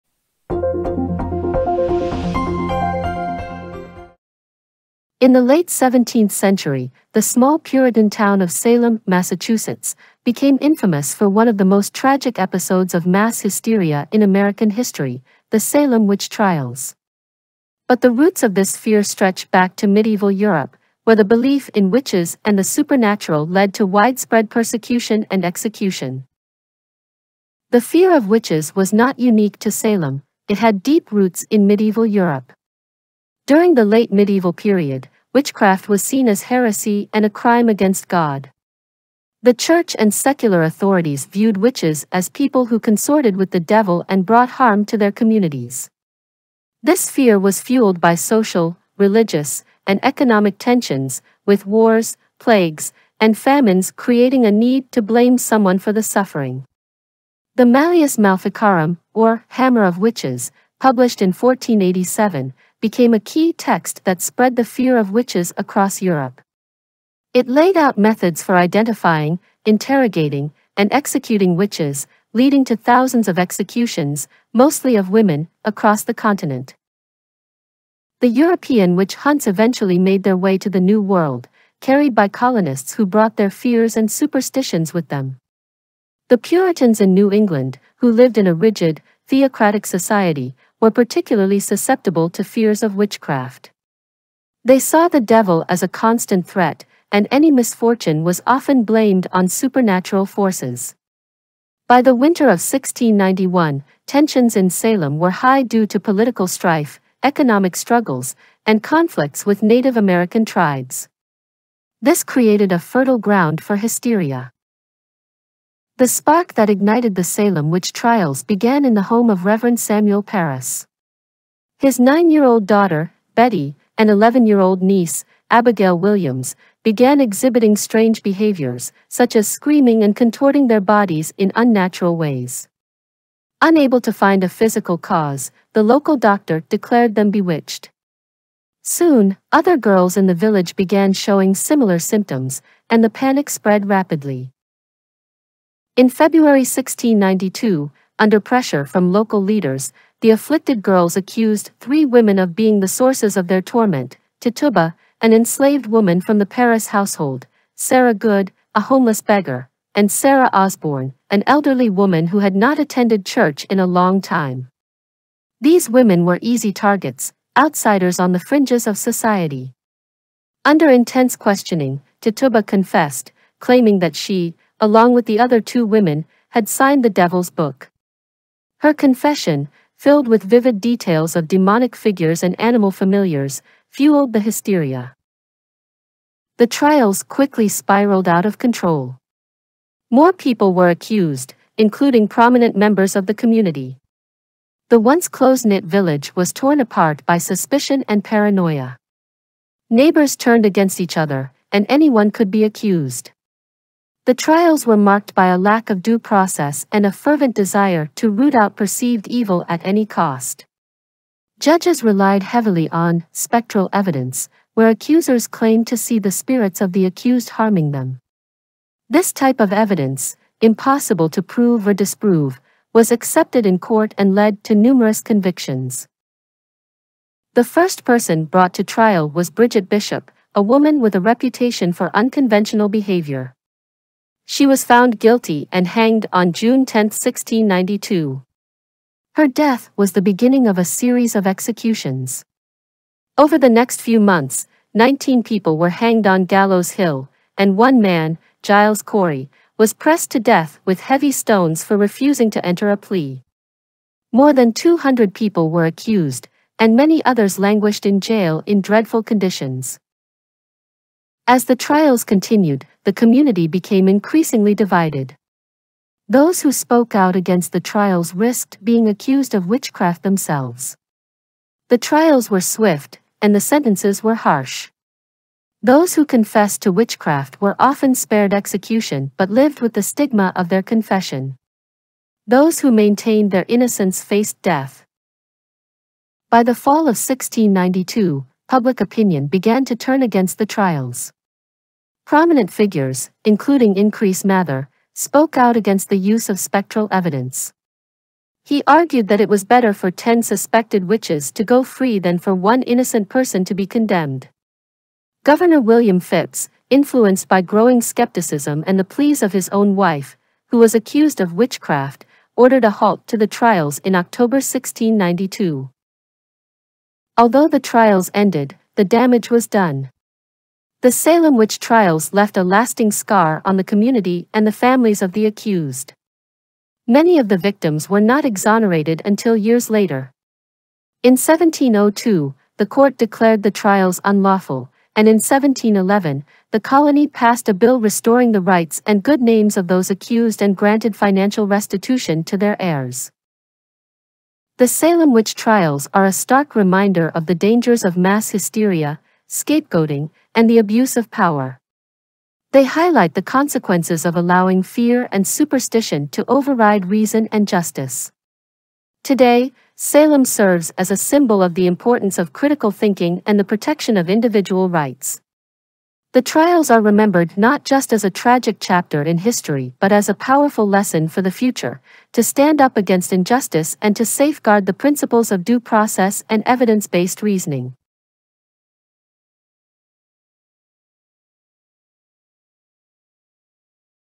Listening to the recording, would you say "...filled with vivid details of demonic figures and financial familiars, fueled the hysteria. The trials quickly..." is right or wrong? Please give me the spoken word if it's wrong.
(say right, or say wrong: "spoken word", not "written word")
wrong: "animal", not "financial".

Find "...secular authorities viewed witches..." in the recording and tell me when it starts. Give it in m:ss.
0:40.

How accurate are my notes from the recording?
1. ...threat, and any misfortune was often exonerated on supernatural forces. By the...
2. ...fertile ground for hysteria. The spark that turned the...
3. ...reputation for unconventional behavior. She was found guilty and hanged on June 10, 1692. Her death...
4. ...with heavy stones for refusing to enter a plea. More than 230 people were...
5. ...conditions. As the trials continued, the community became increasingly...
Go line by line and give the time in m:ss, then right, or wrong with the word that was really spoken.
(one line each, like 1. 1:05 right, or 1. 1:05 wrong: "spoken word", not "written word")
1. 1:36 wrong: "blamed", not "exonerated"
2. 1:52 wrong: "ignited", not "turned"
3. 3:51 right
4. 4:10 wrong: "200", not "230"
5. 4:19 right.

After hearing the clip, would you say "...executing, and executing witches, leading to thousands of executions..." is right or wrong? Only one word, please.
wrong.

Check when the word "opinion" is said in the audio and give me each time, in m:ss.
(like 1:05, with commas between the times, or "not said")
4:49.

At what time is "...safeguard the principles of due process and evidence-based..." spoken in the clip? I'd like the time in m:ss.
6:14.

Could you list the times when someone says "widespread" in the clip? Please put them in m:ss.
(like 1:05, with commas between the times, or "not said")
0:23.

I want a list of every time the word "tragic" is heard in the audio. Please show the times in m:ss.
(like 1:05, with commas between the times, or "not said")
0:11, 6:08.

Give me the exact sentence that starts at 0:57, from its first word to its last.
The Malleus Maleficarum, or Hammer of Witches, published in 1487, became a key text that spread the fear of witches across Europe.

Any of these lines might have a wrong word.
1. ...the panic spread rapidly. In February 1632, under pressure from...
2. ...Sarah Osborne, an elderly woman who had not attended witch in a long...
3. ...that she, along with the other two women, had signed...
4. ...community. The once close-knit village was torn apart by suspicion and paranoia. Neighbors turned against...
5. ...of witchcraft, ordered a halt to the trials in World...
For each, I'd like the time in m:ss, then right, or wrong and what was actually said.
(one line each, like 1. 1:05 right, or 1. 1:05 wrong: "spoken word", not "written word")
1. 2:23 wrong: "1692", not "1632"
2. 2:40 wrong: "church", not "witch"
3. 2:53 right
4. 3:13 right
5. 5:11 wrong: "October", not "World".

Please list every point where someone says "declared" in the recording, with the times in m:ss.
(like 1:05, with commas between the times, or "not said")
2:16, 5:33.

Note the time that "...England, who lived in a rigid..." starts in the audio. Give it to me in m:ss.
1:27.